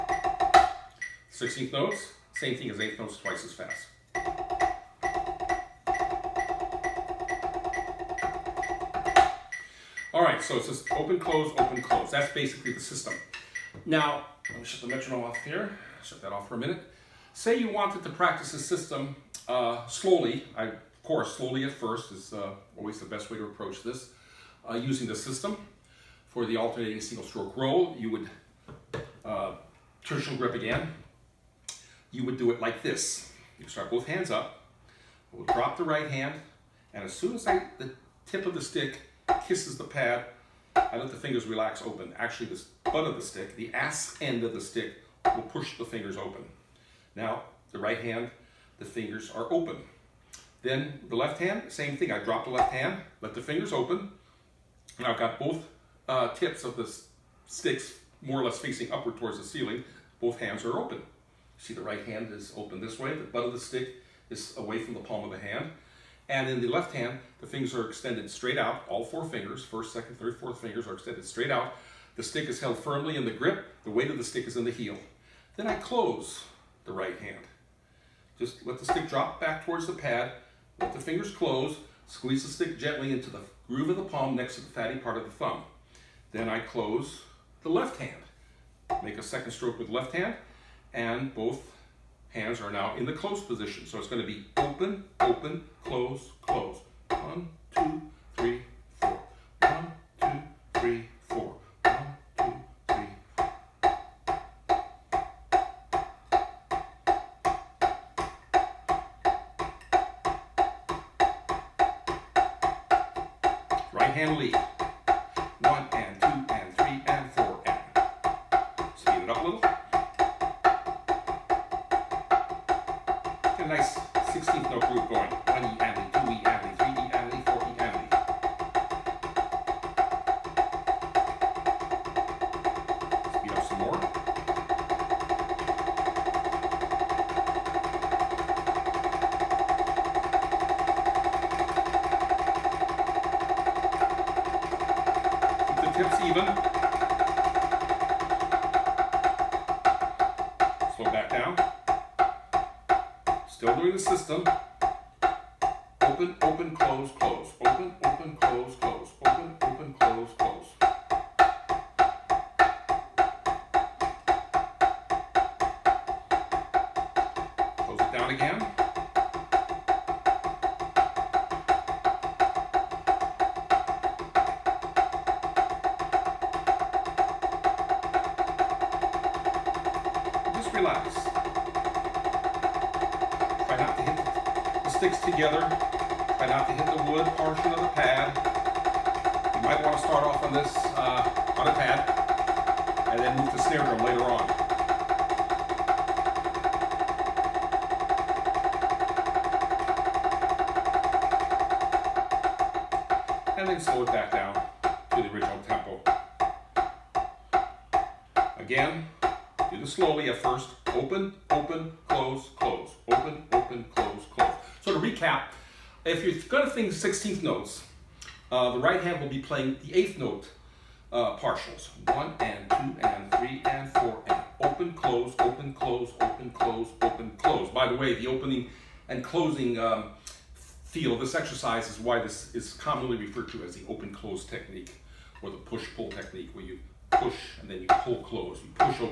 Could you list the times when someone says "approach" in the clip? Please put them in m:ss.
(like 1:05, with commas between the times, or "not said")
0:23.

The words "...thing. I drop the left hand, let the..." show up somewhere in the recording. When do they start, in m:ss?
0:51.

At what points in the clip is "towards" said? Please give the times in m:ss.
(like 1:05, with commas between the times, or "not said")
0:59, 1:19.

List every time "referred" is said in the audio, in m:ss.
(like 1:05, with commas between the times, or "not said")
3:53.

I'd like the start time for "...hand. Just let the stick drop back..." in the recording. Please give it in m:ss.
1:17.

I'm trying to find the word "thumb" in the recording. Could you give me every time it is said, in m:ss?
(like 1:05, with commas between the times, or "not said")
1:25.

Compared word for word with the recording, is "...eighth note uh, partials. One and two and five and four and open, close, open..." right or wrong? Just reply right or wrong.
wrong.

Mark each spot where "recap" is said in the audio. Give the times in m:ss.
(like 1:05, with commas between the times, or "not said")
3:34.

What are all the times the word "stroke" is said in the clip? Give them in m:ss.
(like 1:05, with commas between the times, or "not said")
0:27, 1:29.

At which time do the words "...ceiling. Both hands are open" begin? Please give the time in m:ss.
0:59.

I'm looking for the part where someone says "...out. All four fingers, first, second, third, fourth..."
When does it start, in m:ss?
1:08.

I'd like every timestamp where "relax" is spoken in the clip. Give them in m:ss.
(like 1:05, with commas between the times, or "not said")
0:41, 3:00.